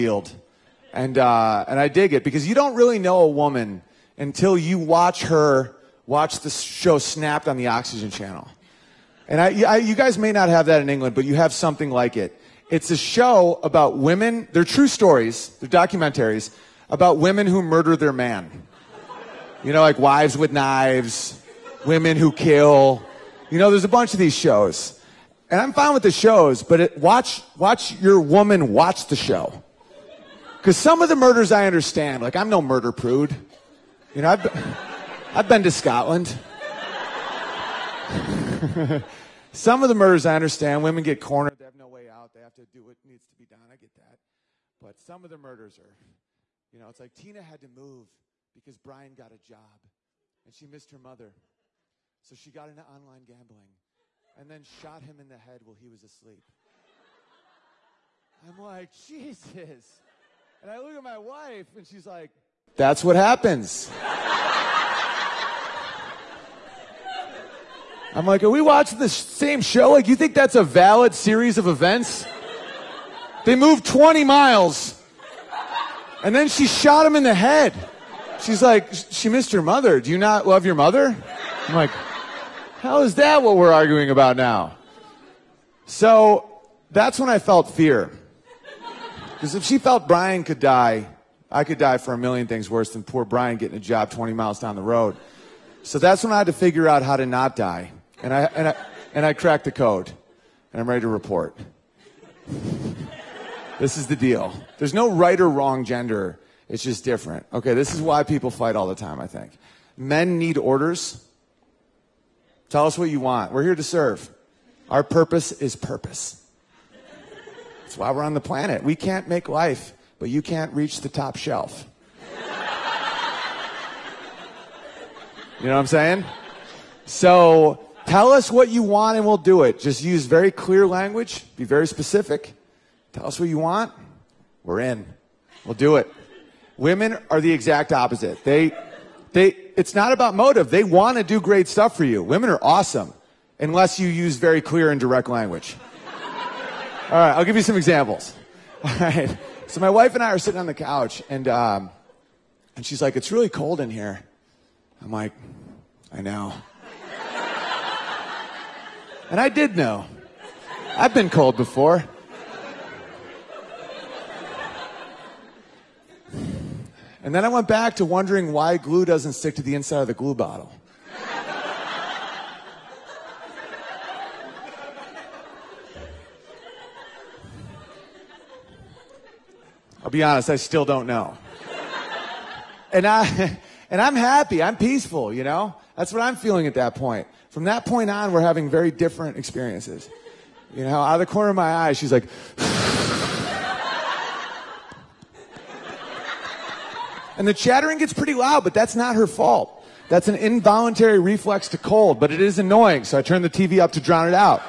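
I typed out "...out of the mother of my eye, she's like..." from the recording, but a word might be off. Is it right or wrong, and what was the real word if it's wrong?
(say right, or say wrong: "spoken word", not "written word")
wrong: "corner", not "mother".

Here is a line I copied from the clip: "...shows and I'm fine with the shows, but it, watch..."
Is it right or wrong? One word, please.
right.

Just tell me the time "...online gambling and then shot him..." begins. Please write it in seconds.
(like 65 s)
52 s.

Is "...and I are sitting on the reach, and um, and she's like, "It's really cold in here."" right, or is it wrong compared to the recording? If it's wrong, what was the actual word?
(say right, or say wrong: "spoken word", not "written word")
wrong: "couch", not "reach".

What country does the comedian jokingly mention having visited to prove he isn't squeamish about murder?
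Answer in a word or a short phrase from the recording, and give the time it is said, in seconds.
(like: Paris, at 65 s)
Scotland, at 35 s.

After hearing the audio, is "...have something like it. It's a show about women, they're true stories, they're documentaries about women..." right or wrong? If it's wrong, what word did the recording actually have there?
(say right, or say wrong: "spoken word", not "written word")
right.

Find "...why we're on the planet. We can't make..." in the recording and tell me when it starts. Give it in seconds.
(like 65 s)
117 s.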